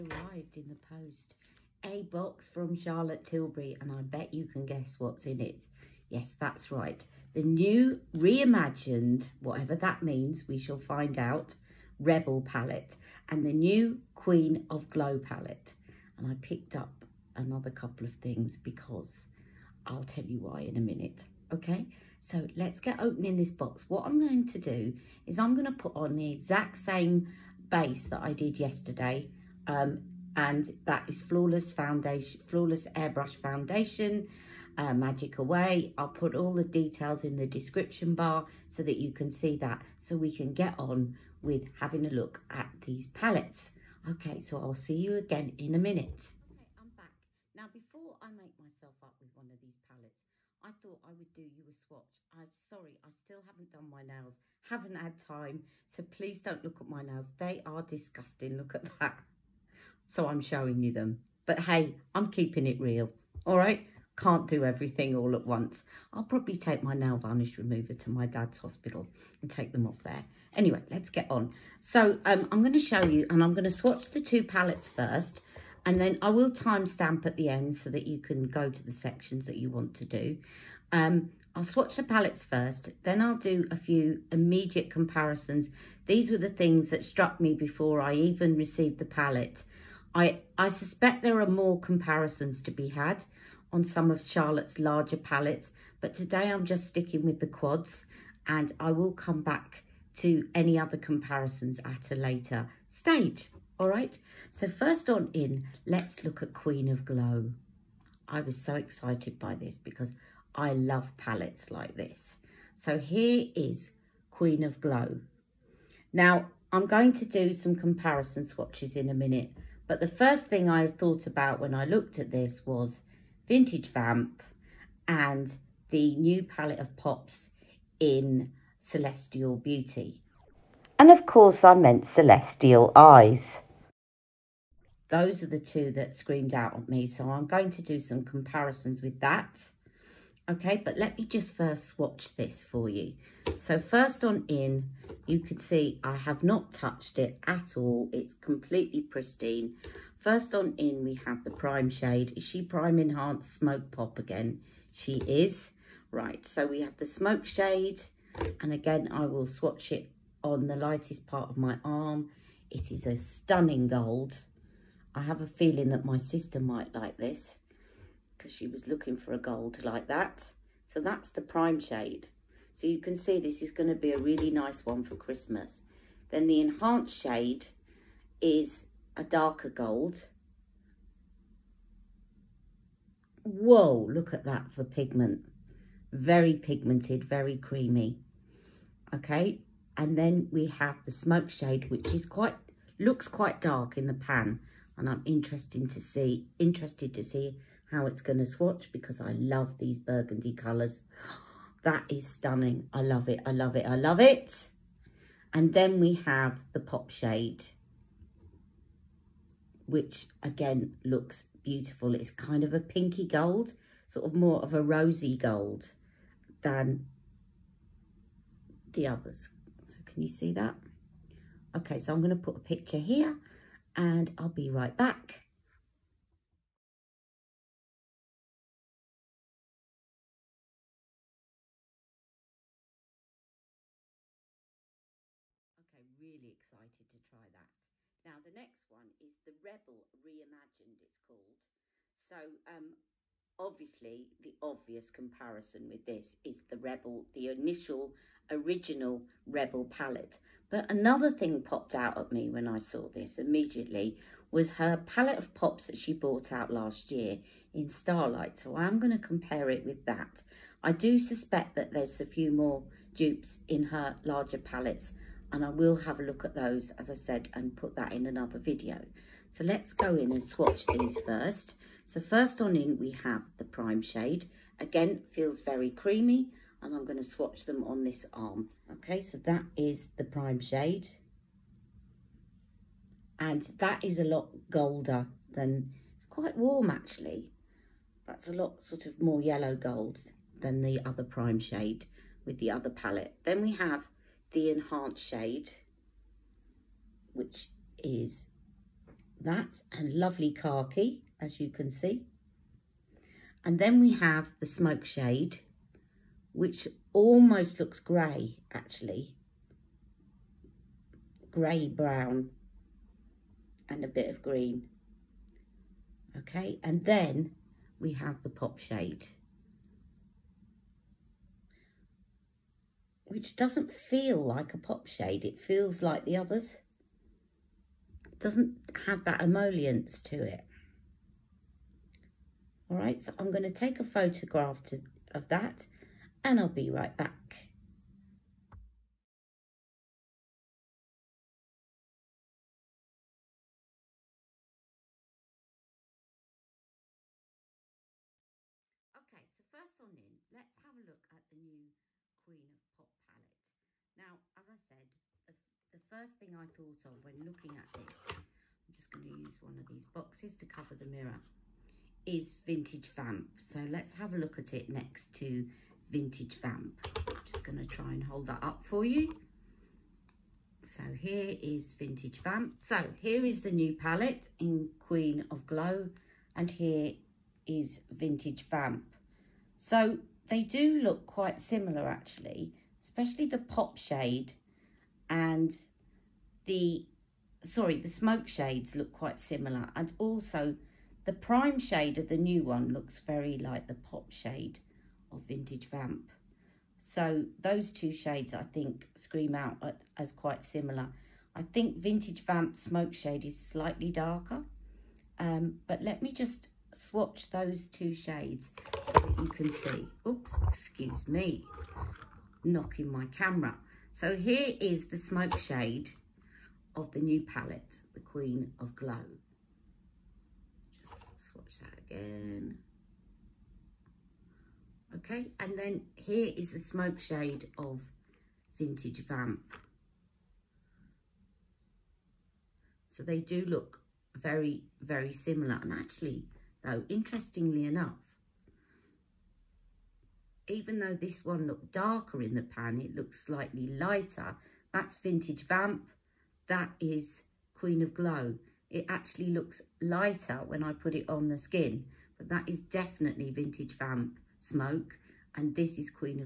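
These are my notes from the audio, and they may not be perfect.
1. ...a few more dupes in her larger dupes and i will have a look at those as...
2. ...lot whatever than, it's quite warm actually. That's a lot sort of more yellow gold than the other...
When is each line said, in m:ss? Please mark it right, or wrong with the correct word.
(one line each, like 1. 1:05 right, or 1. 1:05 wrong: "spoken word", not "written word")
1. 4:22 wrong: "palettes", not "dupes"
2. 4:44 wrong: "golder", not "whatever".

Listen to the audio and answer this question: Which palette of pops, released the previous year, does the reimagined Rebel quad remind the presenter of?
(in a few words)
Starlight.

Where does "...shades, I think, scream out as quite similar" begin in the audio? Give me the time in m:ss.
6:38.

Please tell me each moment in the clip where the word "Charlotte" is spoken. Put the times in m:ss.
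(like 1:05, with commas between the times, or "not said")
0:02, 1:34.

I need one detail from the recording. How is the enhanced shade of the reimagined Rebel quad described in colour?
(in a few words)
khaki.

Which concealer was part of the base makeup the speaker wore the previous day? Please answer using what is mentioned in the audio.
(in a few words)
Magic Away.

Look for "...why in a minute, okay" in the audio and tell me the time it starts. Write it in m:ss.
0:20.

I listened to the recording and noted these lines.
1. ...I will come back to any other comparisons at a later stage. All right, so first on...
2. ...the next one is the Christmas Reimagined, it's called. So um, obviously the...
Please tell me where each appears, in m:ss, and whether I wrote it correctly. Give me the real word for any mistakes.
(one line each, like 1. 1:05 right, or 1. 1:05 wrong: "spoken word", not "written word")
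1. 1:38 right
2. 3:58 wrong: "Rebel", not "Christmas".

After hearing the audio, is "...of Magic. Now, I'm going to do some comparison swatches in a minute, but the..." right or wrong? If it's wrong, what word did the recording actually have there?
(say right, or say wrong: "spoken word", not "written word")
wrong: "Glow", not "Magic".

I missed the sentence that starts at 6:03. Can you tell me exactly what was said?
So let's have a look at it next to Vintage Vamp.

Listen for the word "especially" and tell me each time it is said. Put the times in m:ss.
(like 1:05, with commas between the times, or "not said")
6:23.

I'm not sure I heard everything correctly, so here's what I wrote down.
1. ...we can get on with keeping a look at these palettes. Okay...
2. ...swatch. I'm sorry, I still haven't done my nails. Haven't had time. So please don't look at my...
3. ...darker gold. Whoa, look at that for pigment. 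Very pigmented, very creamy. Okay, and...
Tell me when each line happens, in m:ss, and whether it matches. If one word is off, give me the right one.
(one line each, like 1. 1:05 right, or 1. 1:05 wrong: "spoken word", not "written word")
1. 0:40 wrong: "having", not "keeping"
2. 0:51 right
3. 2:59 right.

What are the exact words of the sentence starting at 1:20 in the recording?
Um, I'll swatch the palettes first, then I'll do a few immediate comparisons.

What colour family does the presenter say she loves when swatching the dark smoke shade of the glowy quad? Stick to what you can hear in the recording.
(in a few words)
burgundy.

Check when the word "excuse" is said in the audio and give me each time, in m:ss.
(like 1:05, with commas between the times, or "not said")
6:50.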